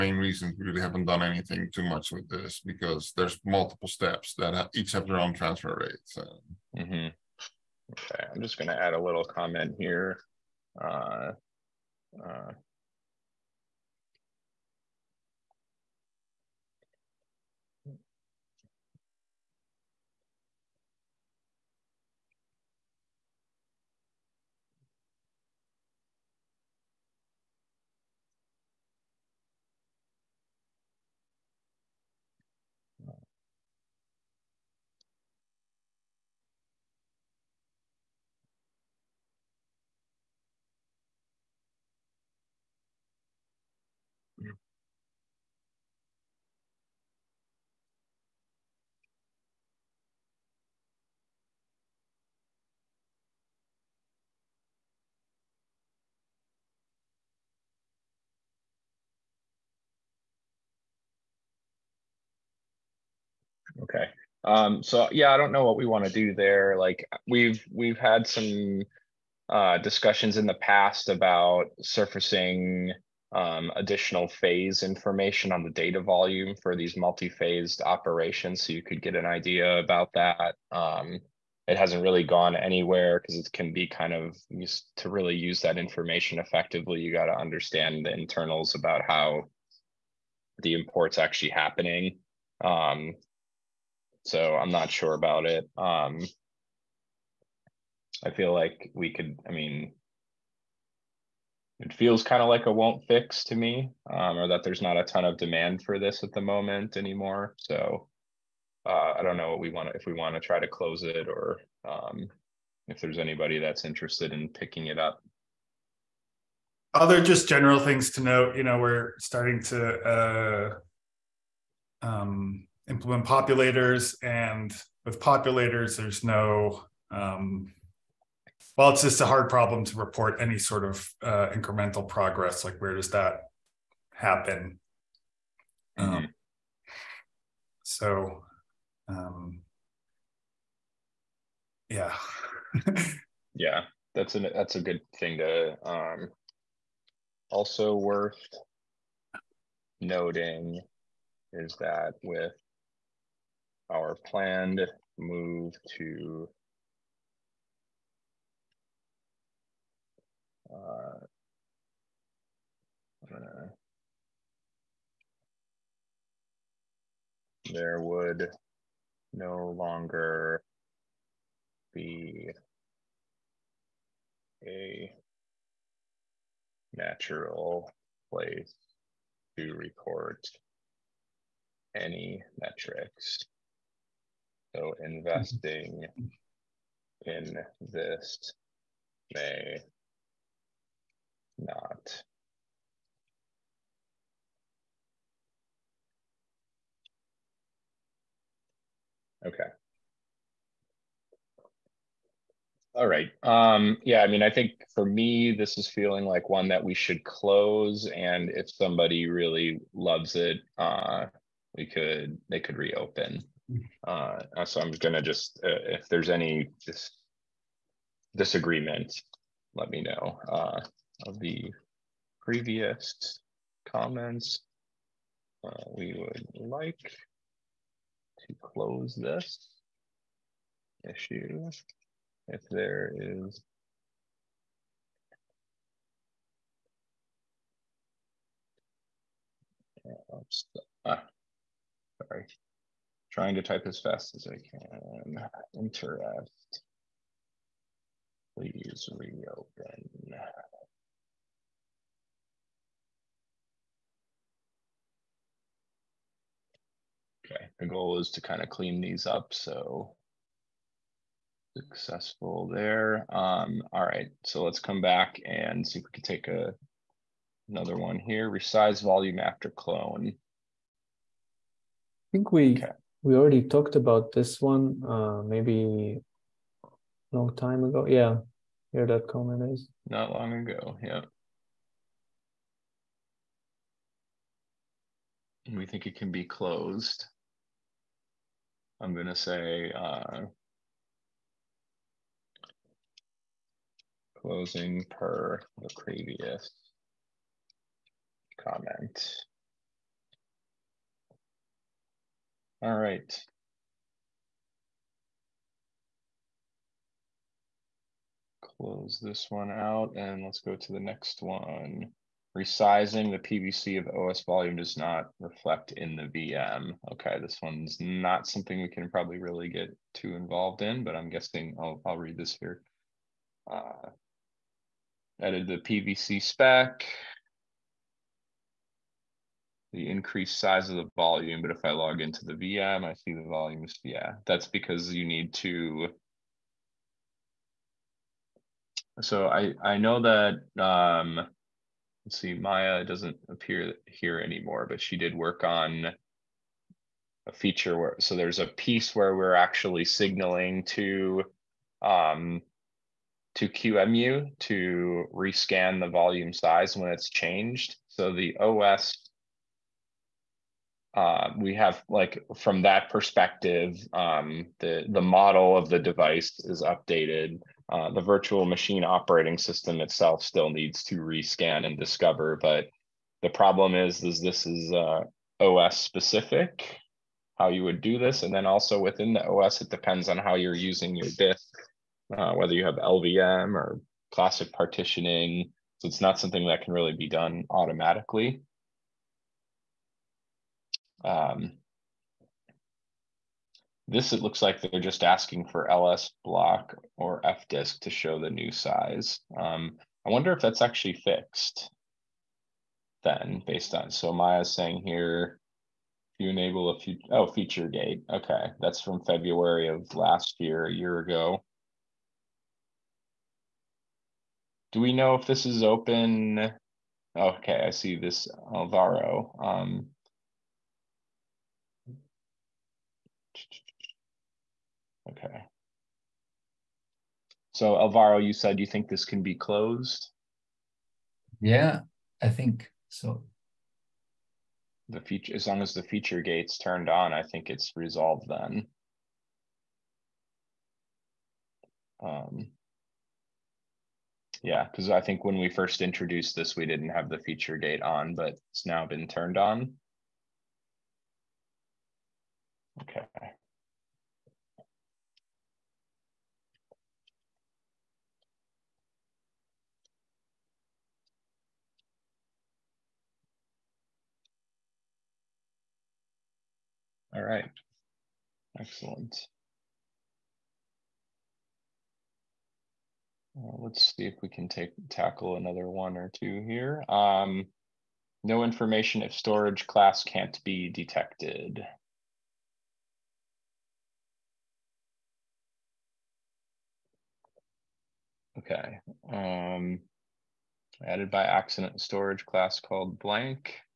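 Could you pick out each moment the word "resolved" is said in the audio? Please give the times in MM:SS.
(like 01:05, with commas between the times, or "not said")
07:17.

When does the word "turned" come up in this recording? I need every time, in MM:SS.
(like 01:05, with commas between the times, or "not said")
07:16, 07:29.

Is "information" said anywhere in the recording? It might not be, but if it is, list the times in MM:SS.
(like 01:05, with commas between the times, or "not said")
01:14, 01:25, 07:58.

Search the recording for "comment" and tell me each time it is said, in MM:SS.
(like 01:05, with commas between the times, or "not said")
00:09, 03:43, 04:39, 04:58.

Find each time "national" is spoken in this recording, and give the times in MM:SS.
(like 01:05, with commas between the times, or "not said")
not said.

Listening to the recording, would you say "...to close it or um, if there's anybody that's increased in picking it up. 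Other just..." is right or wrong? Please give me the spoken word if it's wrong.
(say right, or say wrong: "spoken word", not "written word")
wrong: "interested", not "increased".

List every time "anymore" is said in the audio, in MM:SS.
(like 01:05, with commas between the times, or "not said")
01:46, 05:44.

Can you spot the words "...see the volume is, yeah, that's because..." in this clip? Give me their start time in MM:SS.
05:33.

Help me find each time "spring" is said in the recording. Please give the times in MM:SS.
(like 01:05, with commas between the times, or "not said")
not said.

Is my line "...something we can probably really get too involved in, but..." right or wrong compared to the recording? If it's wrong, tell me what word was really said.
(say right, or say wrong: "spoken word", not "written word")
right.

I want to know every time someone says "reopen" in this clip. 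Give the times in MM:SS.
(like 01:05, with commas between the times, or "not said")
03:32, 04:09.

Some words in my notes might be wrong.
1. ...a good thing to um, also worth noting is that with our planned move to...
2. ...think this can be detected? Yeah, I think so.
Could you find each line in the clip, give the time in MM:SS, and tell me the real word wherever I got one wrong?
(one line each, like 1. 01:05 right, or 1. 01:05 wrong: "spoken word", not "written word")
1. 02:24 right
2. 07:08 wrong: "closed", not "detected".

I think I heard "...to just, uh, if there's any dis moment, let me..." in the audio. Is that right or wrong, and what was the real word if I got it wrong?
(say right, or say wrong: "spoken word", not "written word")
wrong: "disagreement", not "moment".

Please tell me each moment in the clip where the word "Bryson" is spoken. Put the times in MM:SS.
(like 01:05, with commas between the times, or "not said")
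not said.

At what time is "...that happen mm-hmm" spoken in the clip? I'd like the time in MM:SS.
02:13.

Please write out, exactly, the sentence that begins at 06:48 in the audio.
Okay, that's from February of last year, a year ago.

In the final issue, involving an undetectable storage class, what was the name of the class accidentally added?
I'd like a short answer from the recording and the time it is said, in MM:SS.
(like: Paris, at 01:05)
blank, at 08:13.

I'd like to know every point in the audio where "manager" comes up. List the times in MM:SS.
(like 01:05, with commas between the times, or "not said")
not said.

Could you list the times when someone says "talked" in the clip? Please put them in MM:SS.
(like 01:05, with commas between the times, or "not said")
04:33.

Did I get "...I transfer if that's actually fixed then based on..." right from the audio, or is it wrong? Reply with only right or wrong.
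wrong.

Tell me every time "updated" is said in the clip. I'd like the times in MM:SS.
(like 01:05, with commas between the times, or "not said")
06:06.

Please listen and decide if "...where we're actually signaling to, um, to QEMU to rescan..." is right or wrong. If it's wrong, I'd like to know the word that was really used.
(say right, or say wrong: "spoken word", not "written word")
right.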